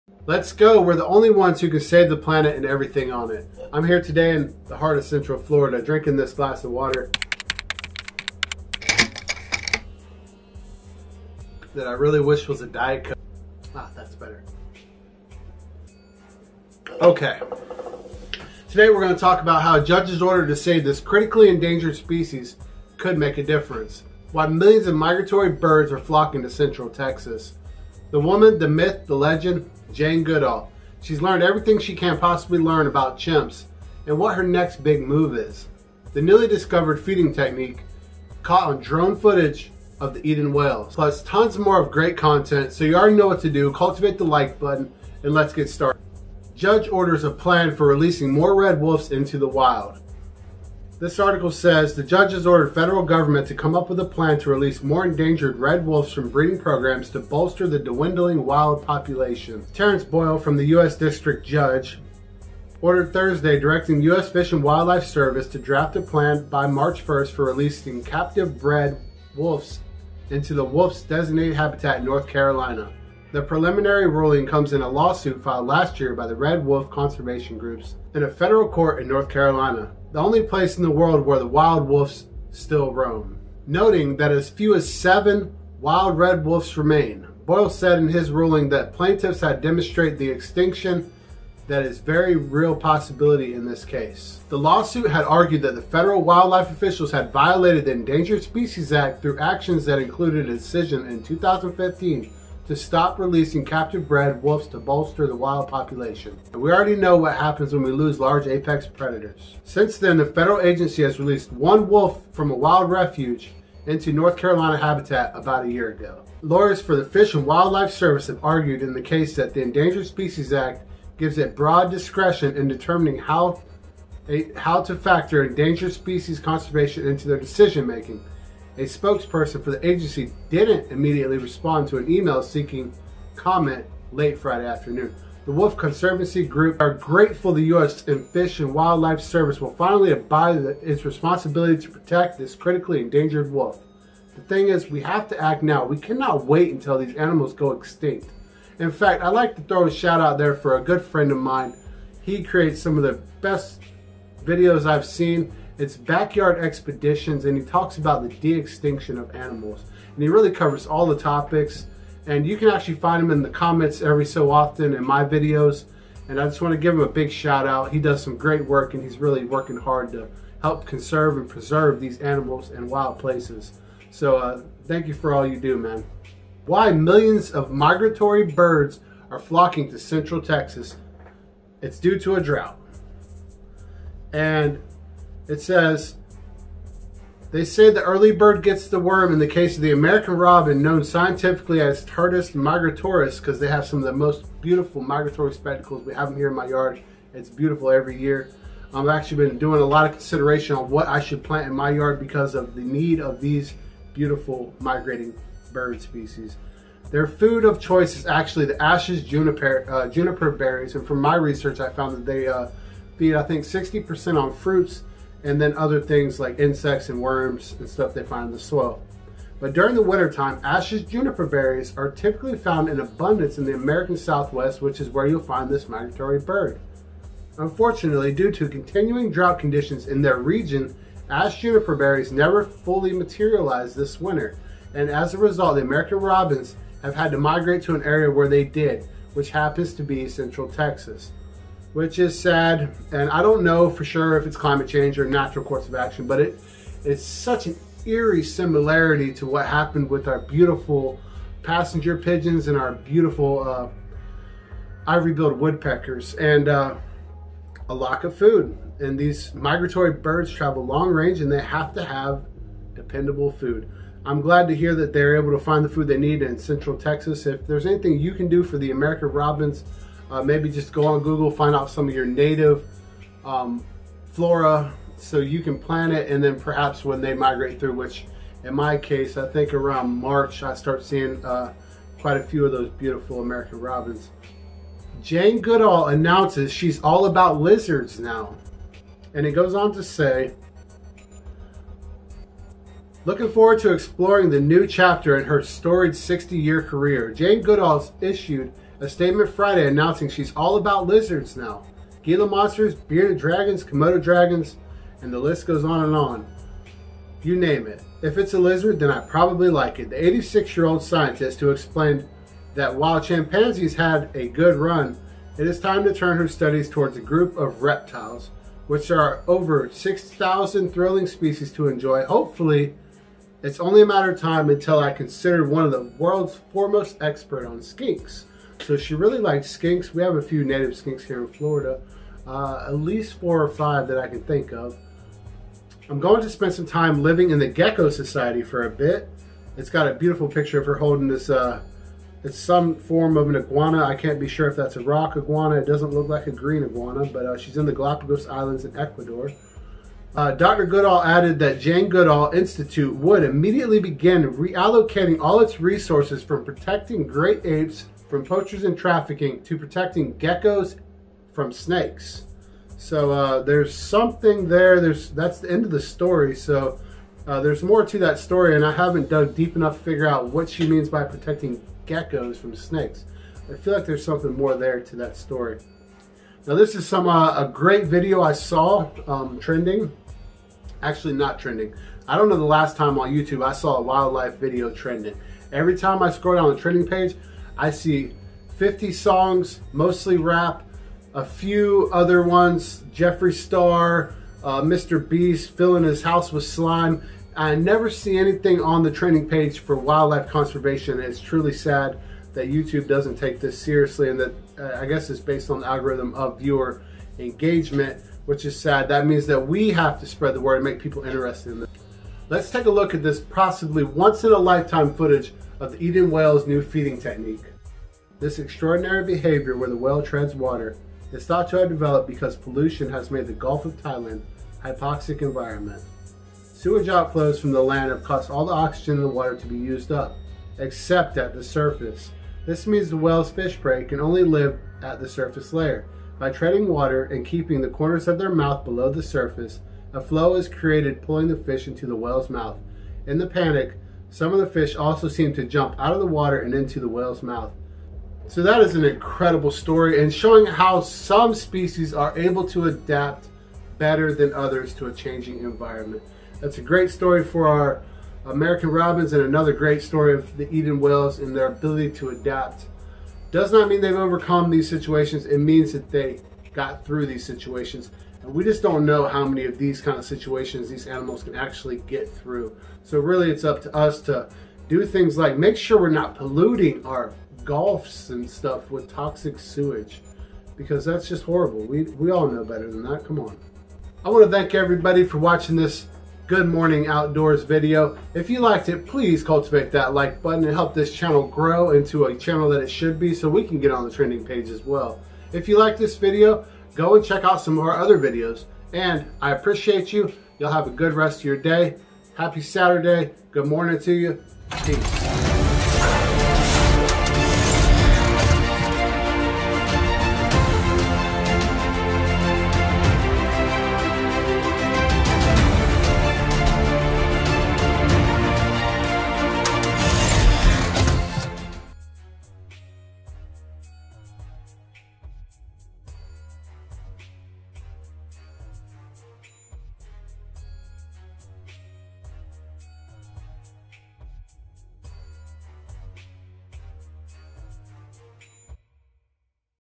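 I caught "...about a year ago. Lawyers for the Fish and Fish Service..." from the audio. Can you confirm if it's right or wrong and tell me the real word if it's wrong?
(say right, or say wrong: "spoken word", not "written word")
wrong: "Wildlife", not "Fish".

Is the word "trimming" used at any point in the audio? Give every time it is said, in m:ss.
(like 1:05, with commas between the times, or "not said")
not said.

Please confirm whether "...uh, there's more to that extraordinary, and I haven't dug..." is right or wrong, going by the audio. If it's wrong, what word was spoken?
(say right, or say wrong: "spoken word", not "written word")
wrong: "story", not "extraordinary".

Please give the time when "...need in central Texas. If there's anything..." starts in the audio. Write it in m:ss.
4:26.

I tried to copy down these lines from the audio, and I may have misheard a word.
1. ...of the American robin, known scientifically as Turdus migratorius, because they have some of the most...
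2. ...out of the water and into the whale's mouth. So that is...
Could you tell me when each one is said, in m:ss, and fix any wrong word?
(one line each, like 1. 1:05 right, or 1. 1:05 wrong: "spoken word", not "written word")
1. 3:09 right
2. 7:25 right.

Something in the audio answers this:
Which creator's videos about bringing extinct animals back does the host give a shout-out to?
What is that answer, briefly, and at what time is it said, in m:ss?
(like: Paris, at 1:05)
Backyard Expeditions, at 2:35.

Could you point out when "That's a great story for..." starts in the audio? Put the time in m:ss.
7:36.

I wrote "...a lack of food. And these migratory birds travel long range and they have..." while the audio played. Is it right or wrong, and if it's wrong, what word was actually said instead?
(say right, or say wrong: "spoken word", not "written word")
right.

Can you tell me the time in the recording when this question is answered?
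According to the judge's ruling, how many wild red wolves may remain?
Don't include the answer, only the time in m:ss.
1:24.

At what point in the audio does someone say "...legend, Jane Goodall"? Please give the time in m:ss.
0:29.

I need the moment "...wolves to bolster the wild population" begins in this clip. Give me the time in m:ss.
1:44.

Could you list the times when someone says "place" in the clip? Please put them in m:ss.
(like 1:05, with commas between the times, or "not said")
1:20, 2:53.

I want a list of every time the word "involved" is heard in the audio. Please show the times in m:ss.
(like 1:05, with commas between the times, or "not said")
not said.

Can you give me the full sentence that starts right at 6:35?
Beast, filling his house with slime.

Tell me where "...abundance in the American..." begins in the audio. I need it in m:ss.
3:42.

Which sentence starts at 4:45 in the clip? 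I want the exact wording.
Jane Goodall announces she's all about lizards now.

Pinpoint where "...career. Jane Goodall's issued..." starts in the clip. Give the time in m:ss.
4:56.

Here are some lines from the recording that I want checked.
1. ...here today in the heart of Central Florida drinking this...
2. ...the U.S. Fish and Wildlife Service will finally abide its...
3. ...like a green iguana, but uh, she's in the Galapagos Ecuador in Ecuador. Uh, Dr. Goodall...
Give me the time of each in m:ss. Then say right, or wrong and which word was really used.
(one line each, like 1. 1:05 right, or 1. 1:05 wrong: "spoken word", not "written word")
1. 0:03 right
2. 2:17 right
3. 5:46 wrong: "Islands", not "Ecuador".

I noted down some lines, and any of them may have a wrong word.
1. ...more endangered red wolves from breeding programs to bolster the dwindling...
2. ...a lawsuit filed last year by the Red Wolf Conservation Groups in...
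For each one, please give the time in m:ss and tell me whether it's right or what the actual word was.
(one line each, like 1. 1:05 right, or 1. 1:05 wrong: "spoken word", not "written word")
1. 0:54 right
2. 1:14 right.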